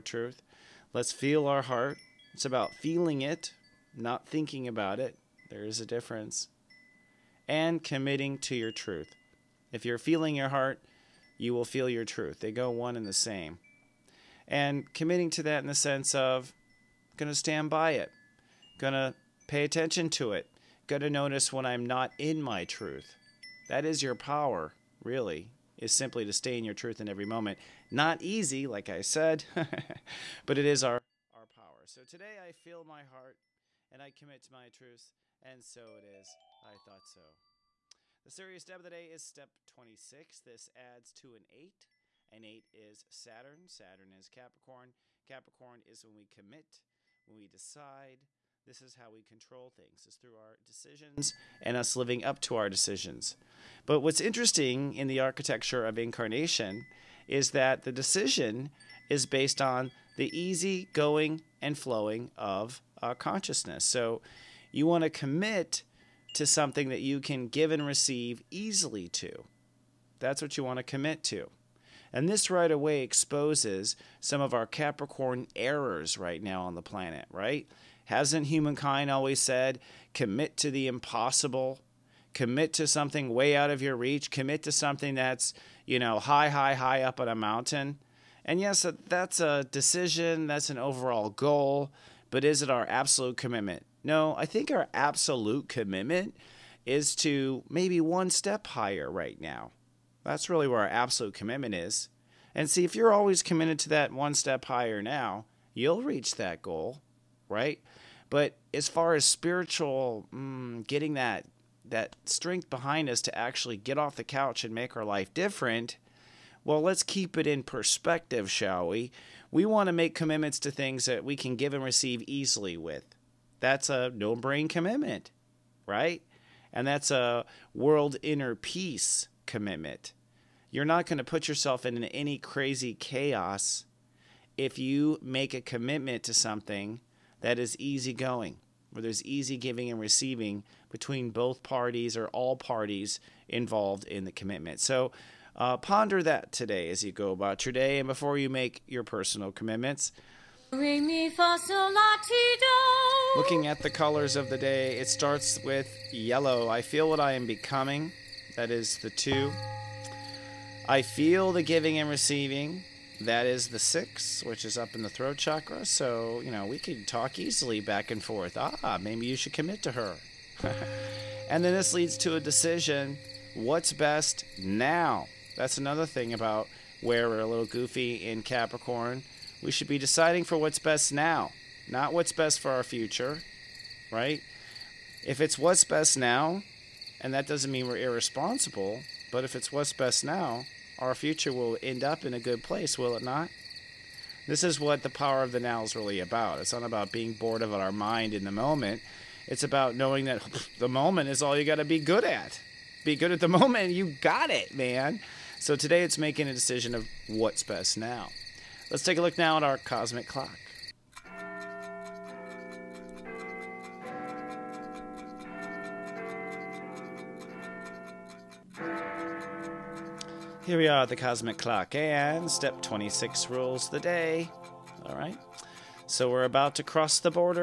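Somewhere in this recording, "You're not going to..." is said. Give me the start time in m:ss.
2:10.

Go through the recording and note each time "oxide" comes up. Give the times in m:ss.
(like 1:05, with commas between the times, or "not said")
not said.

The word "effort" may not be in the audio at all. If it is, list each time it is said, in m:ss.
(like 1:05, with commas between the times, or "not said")
not said.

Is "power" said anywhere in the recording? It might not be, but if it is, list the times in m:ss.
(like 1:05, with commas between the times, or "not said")
0:24, 0:31, 3:15.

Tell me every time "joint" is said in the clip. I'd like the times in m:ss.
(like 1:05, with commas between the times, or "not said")
not said.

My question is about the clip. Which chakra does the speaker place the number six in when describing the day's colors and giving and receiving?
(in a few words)
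Throat chakra.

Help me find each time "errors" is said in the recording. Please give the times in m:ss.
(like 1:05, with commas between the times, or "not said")
1:15.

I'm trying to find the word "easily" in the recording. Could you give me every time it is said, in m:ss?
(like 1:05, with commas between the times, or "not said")
1:08, 2:02, 2:47.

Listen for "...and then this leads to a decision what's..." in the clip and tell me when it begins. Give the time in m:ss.
2:51.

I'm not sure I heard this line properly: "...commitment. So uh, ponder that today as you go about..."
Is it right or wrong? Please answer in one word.
right.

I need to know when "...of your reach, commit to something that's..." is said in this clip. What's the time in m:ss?
1:23.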